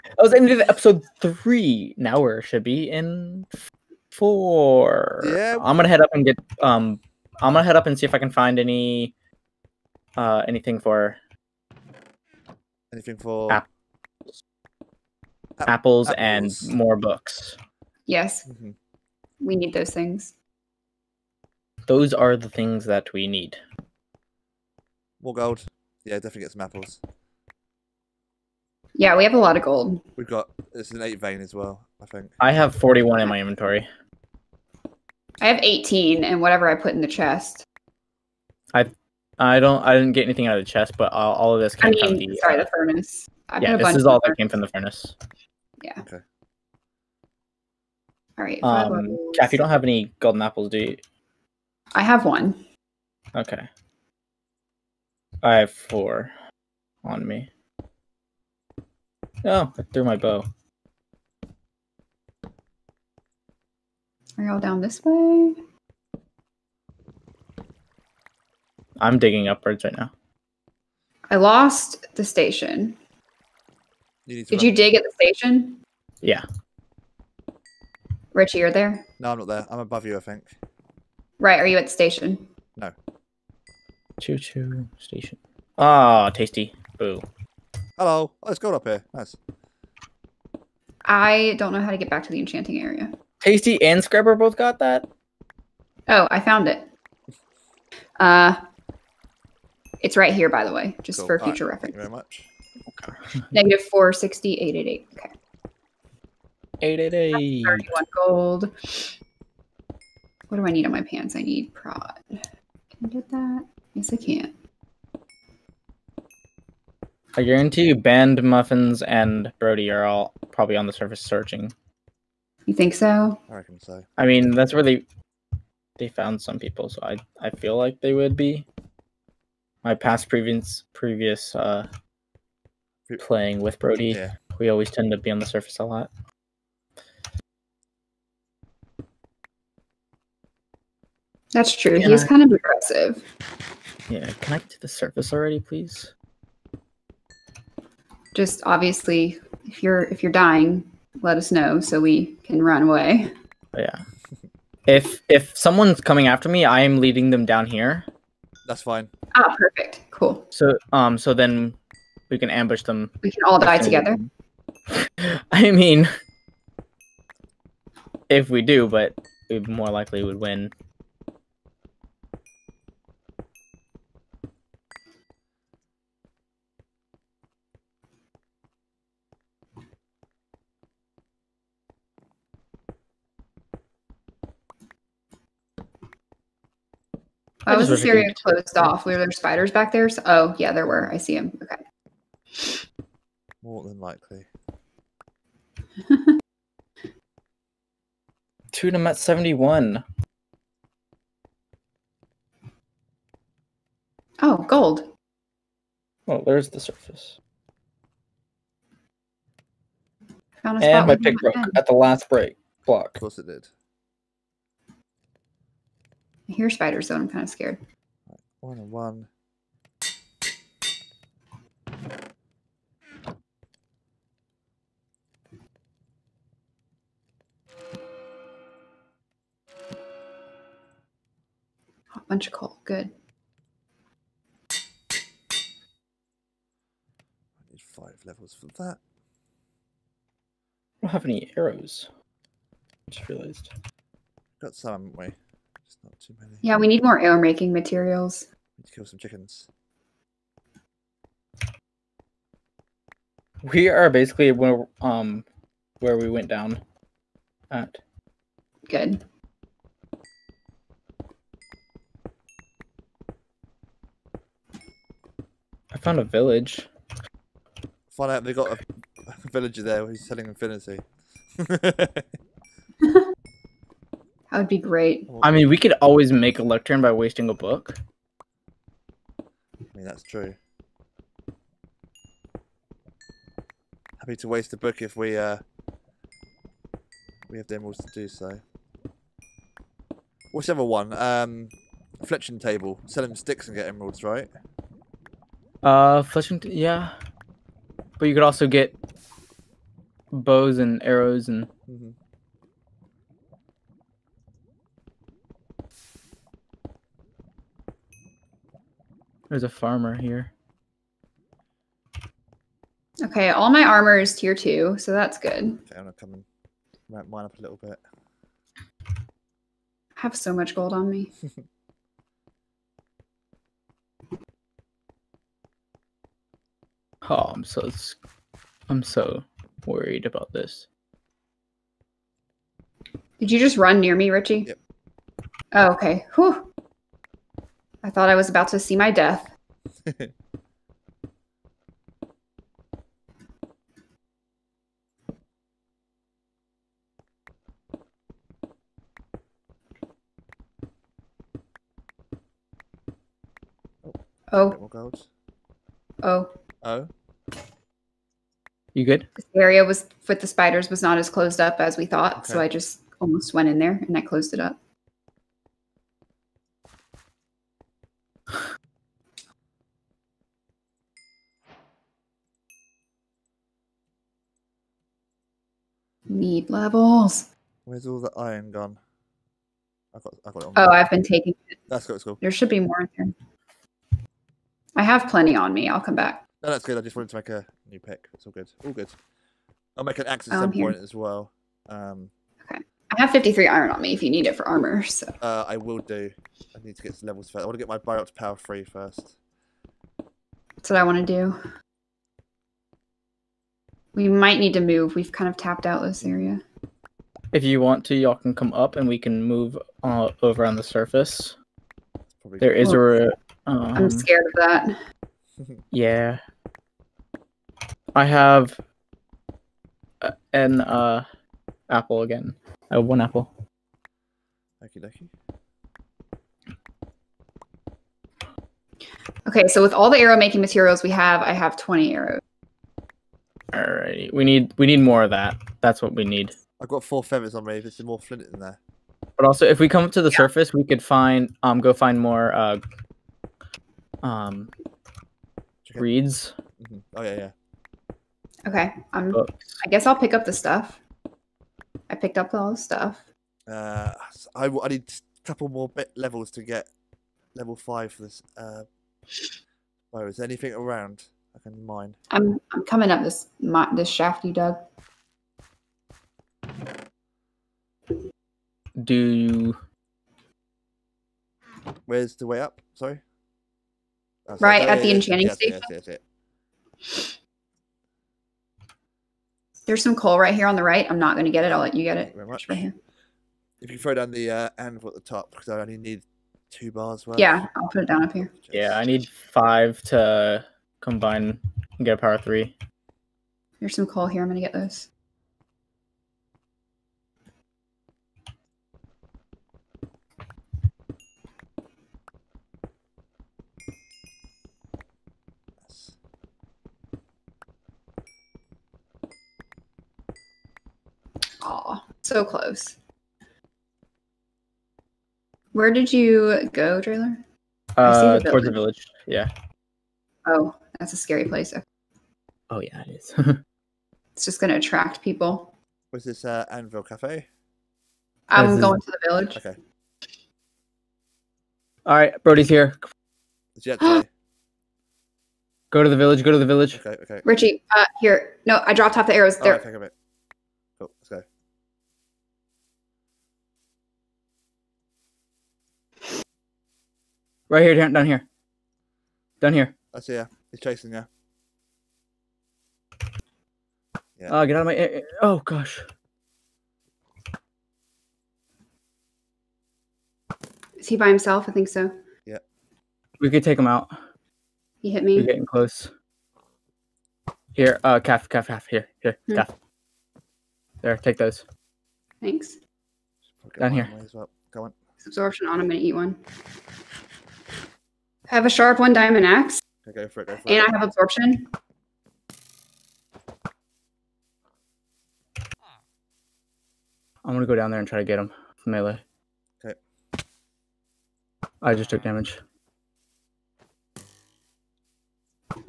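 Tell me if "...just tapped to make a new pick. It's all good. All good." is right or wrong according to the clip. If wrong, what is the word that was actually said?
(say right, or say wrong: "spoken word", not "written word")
wrong: "wanted", not "tapped".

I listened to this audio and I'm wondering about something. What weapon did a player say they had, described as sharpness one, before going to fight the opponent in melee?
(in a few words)
diamond axe.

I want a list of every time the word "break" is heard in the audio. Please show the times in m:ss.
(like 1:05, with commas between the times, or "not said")
3:32.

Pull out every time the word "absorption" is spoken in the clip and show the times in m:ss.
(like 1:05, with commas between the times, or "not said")
9:35, 9:41.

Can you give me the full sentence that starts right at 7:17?
There's some more flint in there.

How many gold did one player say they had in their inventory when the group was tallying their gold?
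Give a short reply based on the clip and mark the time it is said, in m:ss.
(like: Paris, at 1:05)
41, at 0:32.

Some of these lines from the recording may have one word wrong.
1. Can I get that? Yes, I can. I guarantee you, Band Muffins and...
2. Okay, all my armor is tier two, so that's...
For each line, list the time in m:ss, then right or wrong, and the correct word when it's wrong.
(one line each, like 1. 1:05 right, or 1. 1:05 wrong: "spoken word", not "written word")
1. 1:52 right
2. 5:13 right.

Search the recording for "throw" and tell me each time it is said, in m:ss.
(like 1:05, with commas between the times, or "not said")
8:03.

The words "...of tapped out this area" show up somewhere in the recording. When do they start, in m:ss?
6:45.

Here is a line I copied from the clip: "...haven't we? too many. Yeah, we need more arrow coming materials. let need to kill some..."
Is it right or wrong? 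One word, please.
wrong.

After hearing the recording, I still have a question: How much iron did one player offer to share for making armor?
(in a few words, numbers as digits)
53.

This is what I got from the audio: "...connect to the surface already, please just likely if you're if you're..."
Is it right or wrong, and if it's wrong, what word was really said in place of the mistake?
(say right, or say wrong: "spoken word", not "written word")
wrong: "obviously", not "likely".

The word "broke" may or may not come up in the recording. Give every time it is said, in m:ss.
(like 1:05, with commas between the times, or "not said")
3:31.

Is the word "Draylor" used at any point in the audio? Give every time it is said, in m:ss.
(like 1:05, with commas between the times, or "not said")
8:37.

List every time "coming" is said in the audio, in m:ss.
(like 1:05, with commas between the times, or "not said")
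2:36, 7:42.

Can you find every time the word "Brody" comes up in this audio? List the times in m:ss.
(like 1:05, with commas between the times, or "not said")
1:59, 2:13, 8:52.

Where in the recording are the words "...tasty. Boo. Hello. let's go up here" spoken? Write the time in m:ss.
1:26.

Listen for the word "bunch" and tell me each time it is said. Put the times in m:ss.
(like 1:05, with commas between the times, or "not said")
3:52.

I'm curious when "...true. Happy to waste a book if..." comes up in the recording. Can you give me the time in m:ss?
4:40.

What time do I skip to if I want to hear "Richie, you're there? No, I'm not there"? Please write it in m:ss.
1:18.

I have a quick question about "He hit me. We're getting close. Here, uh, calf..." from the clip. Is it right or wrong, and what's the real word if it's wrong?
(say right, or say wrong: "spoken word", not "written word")
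right.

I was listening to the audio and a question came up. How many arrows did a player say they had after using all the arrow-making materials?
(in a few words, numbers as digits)
20.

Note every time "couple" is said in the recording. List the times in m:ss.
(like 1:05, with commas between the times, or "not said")
7:35.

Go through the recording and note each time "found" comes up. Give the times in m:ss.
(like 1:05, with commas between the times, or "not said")
1:36, 2:06, 3:30, 4:26.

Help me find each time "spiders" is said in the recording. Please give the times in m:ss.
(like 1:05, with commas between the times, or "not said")
3:09, 3:36, 6:00.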